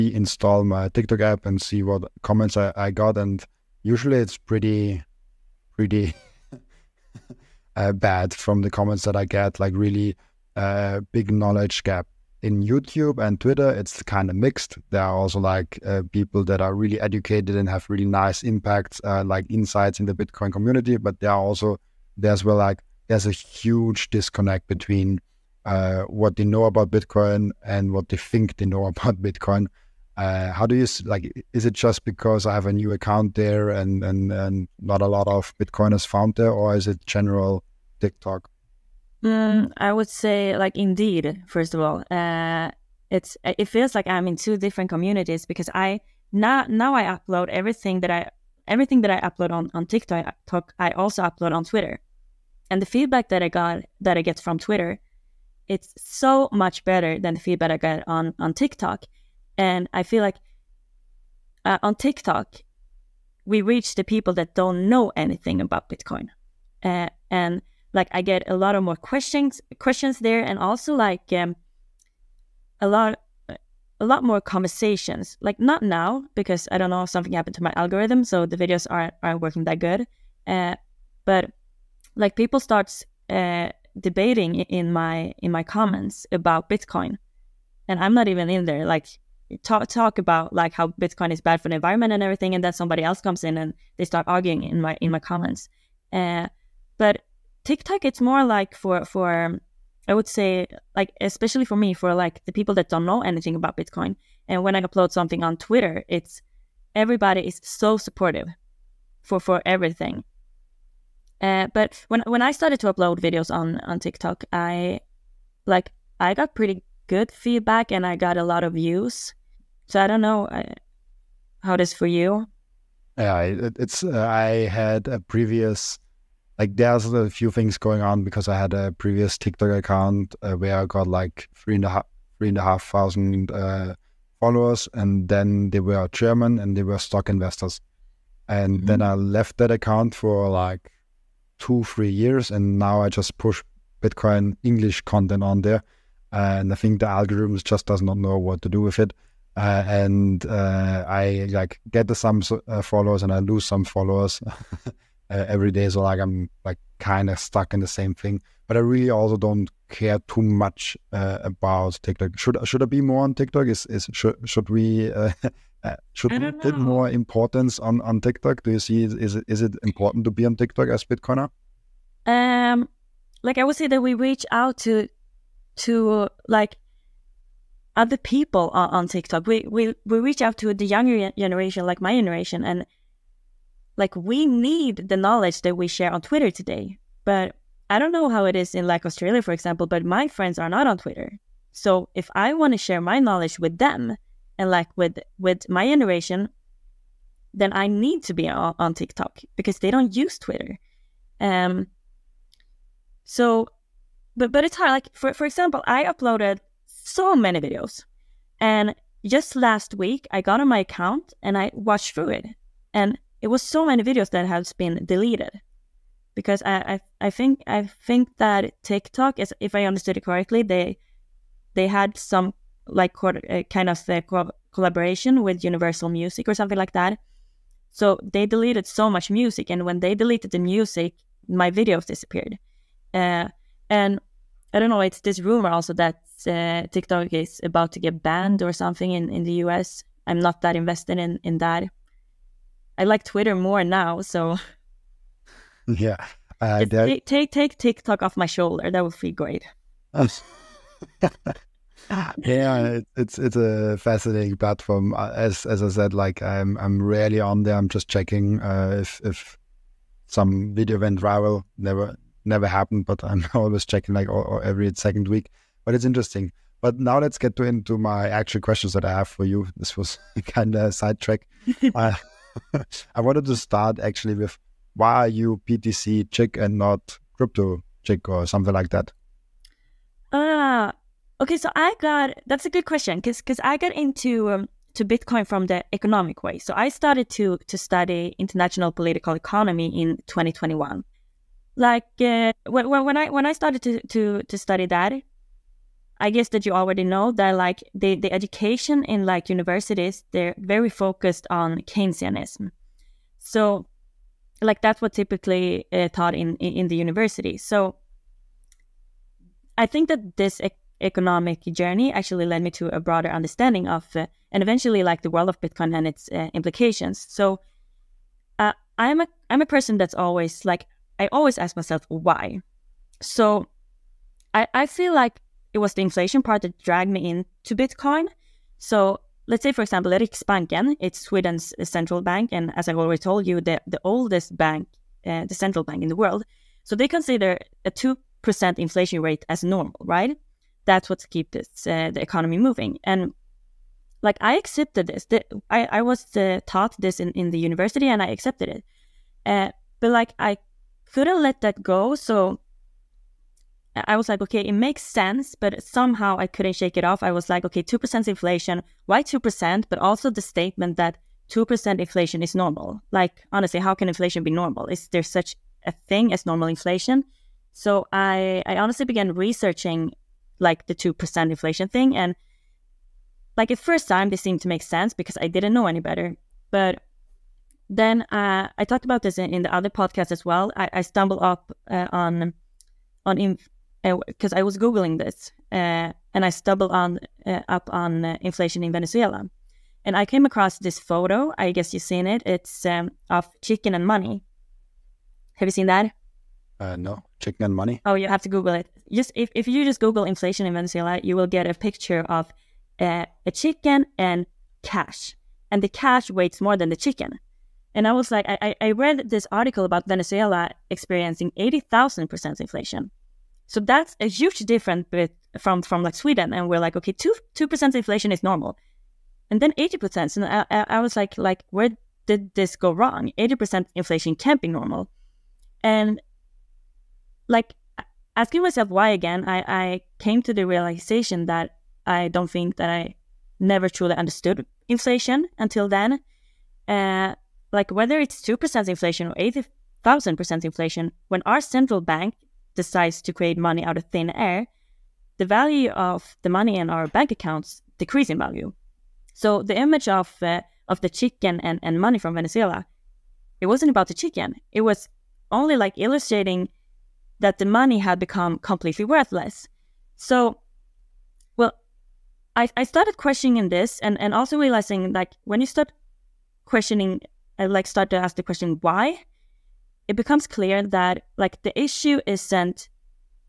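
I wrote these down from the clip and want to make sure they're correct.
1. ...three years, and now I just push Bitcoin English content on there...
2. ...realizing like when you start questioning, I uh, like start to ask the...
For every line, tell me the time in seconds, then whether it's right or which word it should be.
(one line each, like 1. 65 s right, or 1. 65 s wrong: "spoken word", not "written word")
1. 141 s right
2. 464 s right.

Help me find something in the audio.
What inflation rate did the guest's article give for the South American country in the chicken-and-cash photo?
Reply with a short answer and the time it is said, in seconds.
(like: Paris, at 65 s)
80,000%, at 411 s.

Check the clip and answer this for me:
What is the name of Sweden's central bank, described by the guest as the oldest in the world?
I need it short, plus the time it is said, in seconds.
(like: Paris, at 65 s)
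Riksbanken, at 330 s.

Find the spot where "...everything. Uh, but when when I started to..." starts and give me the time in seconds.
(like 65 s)
109 s.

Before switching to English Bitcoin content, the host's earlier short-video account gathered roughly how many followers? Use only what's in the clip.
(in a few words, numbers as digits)
3,500.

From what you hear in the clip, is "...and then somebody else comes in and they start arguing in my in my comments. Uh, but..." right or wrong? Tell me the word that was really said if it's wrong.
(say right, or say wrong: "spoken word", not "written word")
right.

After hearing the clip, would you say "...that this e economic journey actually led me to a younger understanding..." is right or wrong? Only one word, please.
wrong.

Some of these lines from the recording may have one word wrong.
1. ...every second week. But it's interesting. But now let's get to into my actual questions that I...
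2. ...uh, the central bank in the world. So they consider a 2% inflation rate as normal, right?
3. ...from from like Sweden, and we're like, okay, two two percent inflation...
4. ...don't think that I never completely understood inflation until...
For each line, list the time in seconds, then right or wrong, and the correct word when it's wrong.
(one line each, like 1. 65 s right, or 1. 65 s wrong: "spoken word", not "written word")
1. 264 s right
2. 335 s right
3. 415 s right
4. 432 s wrong: "truly", not "completely".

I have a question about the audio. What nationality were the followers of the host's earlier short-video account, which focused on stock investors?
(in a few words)
German.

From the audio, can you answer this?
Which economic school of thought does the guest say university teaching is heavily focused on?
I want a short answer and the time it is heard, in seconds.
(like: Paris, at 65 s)
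Keynesianism, at 301 s.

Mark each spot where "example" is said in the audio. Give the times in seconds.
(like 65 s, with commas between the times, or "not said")
189 s, 205 s, 329 s.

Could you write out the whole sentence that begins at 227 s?
So they deleted so much music, and when they deleted the music, my videos disappeared.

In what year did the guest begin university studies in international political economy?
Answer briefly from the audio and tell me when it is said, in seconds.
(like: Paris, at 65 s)
2021, at 290 s.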